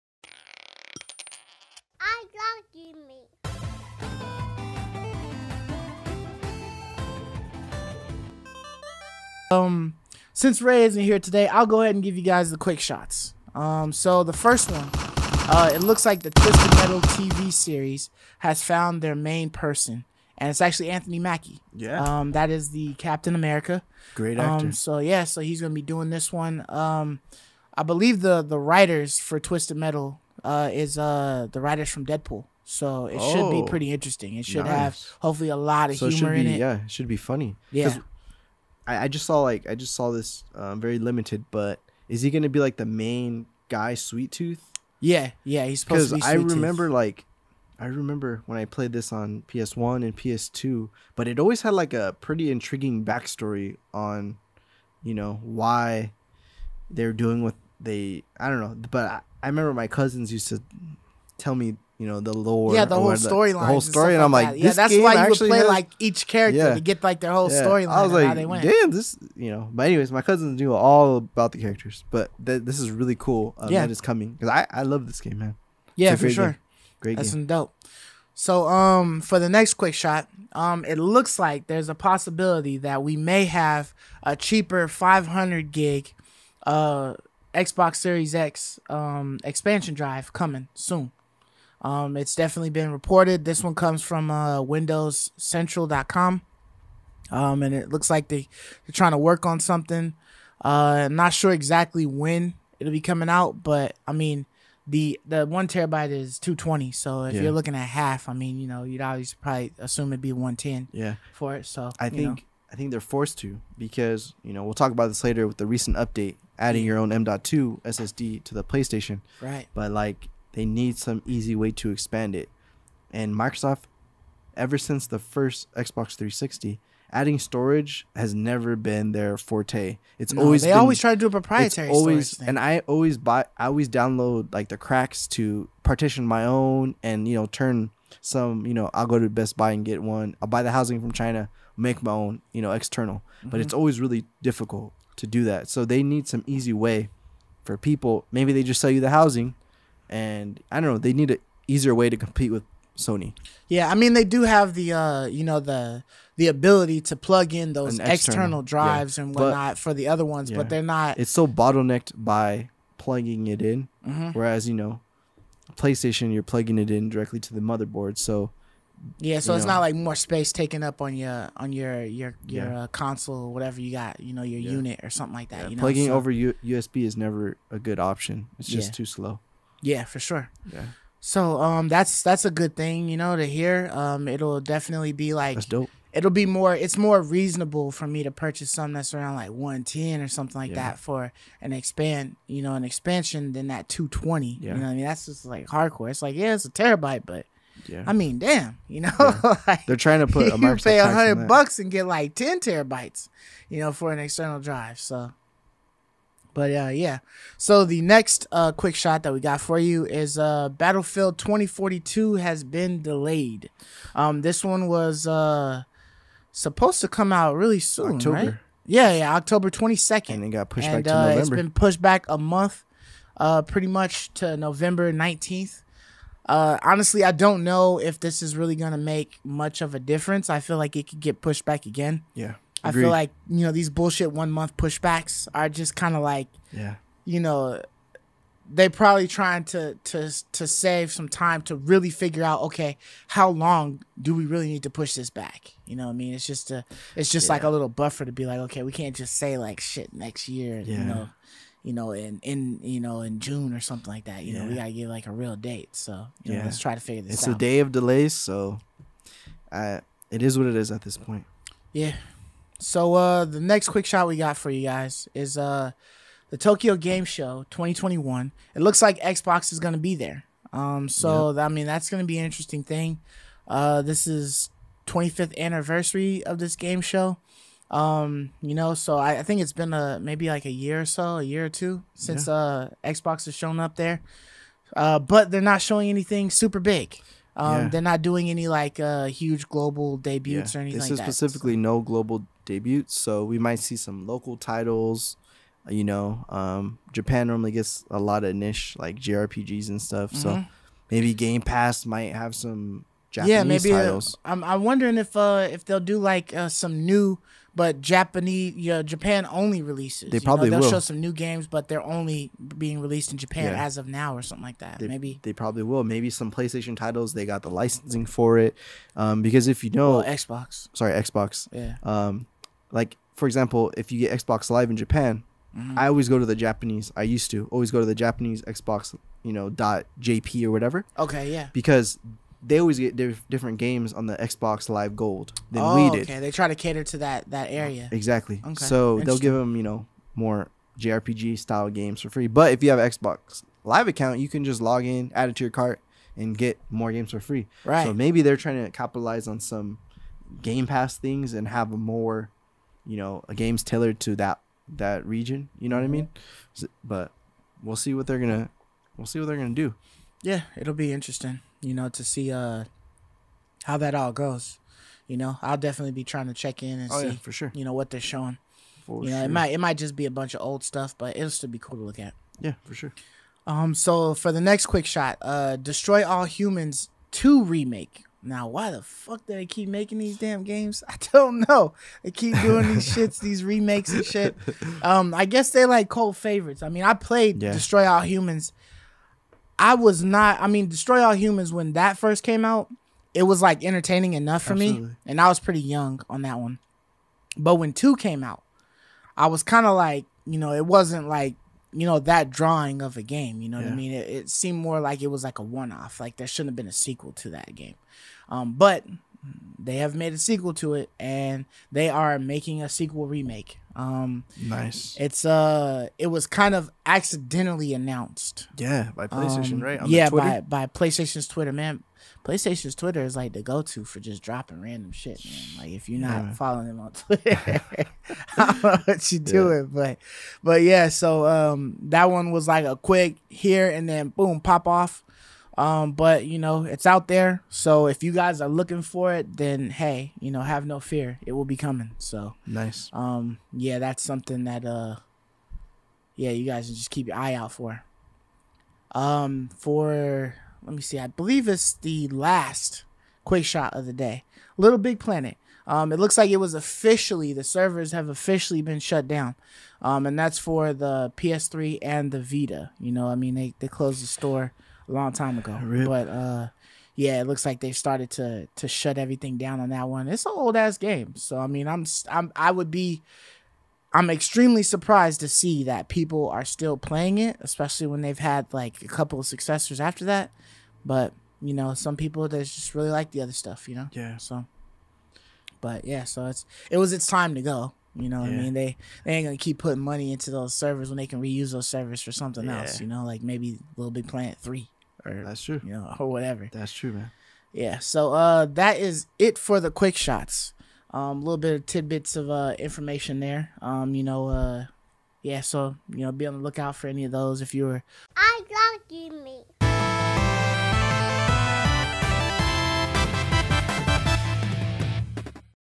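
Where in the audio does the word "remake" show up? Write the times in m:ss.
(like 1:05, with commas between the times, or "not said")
6:17, 6:23, 6:53.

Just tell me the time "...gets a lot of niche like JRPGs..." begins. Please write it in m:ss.
4:57.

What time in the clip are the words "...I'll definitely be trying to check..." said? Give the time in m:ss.
6:05.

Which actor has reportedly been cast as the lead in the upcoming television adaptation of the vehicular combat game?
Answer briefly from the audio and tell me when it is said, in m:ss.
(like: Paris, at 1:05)
Anthony Mackie, at 0:20.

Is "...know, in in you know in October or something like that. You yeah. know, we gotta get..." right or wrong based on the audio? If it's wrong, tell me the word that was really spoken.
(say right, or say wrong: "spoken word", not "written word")
wrong: "June", not "October".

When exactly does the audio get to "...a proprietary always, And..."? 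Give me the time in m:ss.
2:11.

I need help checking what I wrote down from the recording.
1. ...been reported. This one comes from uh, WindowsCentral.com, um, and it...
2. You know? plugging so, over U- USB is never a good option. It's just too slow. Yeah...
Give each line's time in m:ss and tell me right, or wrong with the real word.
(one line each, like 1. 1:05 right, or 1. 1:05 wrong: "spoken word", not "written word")
1. 1:32 right
2. 2:55 right.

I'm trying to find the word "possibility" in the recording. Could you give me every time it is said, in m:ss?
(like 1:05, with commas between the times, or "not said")
1:21.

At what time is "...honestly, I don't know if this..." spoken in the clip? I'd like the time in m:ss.
3:46.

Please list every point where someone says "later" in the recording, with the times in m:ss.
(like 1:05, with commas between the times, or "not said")
1:55.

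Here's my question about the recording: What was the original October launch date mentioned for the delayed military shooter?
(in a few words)
October 22.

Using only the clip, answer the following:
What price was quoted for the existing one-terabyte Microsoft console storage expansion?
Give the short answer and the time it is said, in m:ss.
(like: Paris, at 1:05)
220, at 1:46.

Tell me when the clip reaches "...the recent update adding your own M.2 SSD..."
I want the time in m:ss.
1:55.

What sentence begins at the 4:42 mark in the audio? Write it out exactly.
uh Xbox has shown up there.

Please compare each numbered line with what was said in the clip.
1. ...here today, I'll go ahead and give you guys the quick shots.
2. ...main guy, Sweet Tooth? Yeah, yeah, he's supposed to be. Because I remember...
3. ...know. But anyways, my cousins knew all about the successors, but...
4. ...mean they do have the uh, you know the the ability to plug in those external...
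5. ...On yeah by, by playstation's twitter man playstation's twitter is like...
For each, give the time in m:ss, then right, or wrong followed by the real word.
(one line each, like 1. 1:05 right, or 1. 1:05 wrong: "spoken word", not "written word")
1. 0:11 right
2. 0:42 right
3. 1:09 wrong: "characters", not "successors"
4. 2:33 right
5. 6:59 right.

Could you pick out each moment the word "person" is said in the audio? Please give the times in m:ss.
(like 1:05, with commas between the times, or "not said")
0:19.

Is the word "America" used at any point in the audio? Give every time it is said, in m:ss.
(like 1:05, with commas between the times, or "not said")
0:23.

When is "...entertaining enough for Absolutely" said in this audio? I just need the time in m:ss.
6:33.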